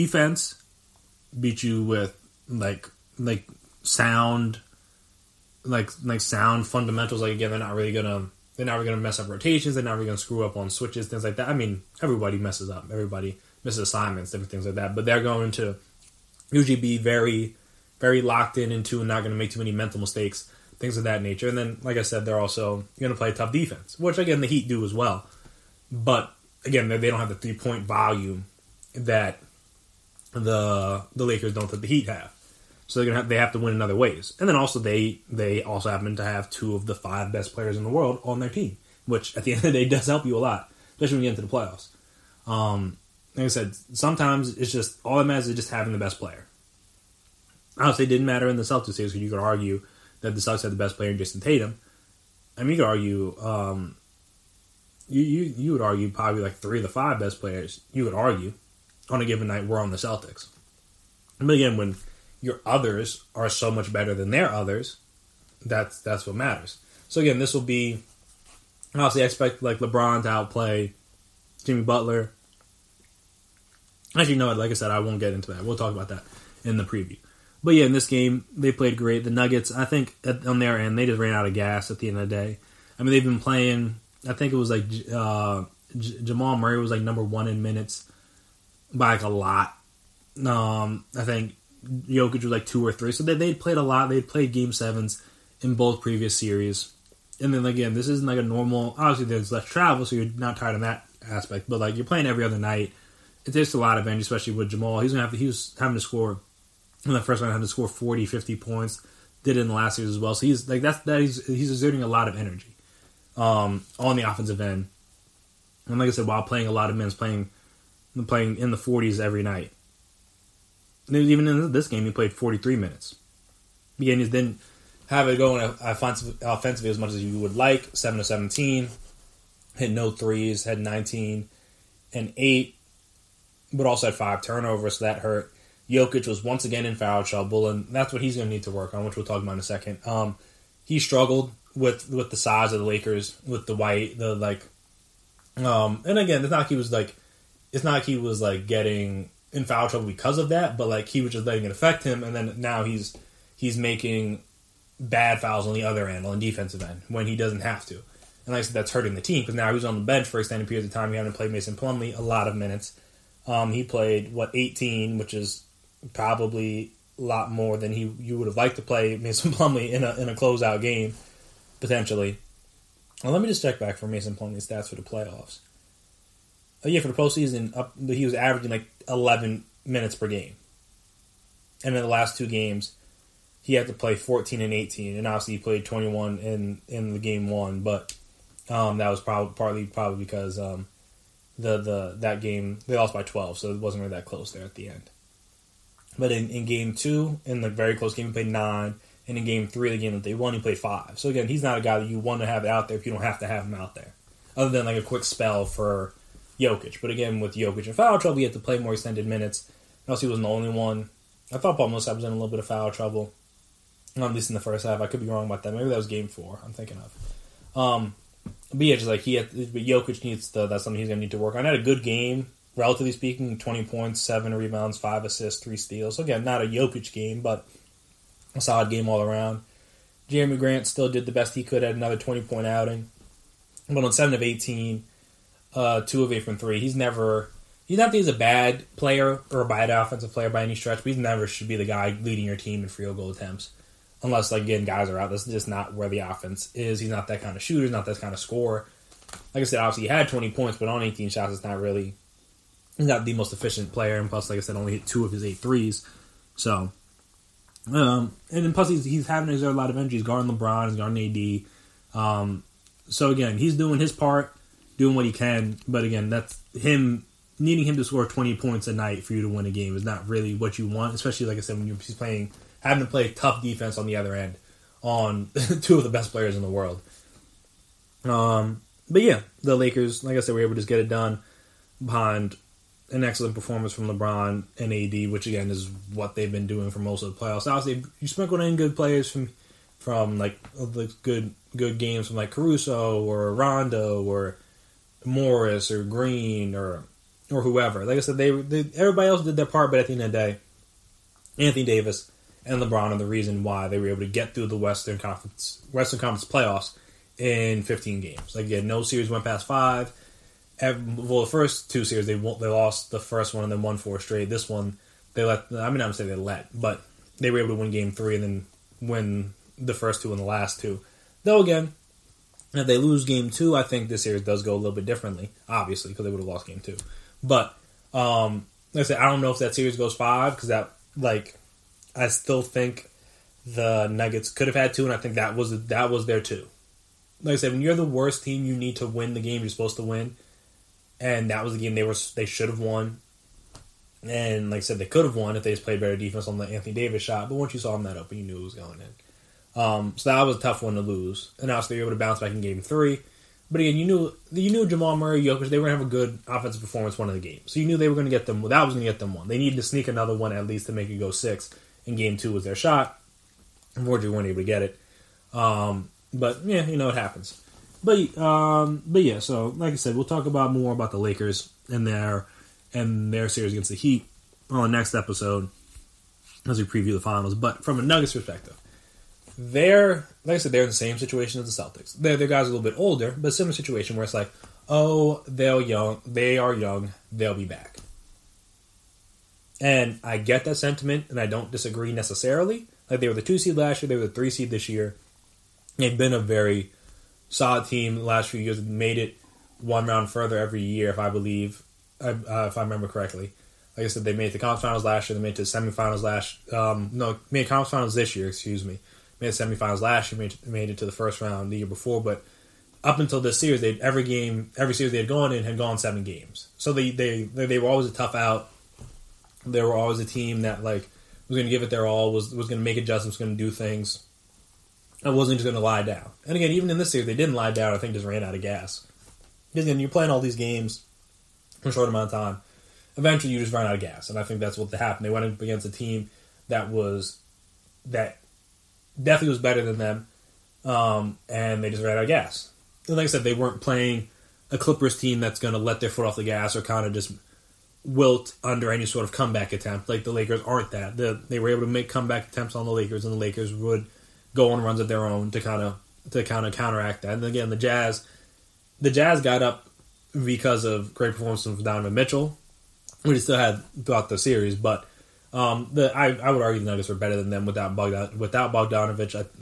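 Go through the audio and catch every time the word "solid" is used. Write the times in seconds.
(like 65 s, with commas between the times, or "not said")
228 s, 397 s.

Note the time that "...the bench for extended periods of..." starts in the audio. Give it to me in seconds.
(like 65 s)
159 s.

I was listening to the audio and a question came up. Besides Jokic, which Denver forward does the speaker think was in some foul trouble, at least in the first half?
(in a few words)
Paul Millsap.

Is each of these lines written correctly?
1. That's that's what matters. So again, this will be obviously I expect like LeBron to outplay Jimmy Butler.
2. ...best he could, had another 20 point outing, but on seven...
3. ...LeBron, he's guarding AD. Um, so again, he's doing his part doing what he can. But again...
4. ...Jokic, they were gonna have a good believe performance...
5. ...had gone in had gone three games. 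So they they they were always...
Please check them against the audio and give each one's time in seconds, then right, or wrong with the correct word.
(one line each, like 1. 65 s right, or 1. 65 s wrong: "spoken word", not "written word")
1. 65 s right
2. 231 s right
3. 260 s right
4. 355 s wrong: "offensive", not "believe"
5. 415 s wrong: "seven", not "three".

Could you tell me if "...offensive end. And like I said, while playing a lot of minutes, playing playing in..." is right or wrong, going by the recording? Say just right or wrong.
right.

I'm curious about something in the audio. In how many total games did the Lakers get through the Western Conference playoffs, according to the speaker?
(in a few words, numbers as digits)
15.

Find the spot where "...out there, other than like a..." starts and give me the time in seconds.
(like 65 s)
203 s.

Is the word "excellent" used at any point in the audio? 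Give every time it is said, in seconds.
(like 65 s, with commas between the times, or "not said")
283 s.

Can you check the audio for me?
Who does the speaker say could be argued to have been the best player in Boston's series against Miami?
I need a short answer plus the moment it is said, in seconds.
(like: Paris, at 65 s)
Jayson Tatum, at 51 s.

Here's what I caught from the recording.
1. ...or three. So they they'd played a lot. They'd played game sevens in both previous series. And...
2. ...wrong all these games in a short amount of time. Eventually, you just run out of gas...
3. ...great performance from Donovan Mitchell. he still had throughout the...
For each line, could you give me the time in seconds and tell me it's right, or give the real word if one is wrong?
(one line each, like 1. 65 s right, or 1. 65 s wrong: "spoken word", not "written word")
1. 92 s right
2. 430 s wrong: "playing", not "wrong"
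3. 461 s right.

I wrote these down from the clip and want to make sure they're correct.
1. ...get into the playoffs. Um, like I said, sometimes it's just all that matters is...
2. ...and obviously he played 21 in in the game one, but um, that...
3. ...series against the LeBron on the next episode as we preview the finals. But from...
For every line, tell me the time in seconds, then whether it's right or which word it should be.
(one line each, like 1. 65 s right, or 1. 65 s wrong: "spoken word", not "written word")
1. 41 s right
2. 185 s right
3. 373 s wrong: "Heat", not "LeBron".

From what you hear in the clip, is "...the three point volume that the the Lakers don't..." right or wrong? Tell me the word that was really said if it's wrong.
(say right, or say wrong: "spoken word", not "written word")
right.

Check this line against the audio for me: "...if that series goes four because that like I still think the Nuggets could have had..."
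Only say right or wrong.
wrong.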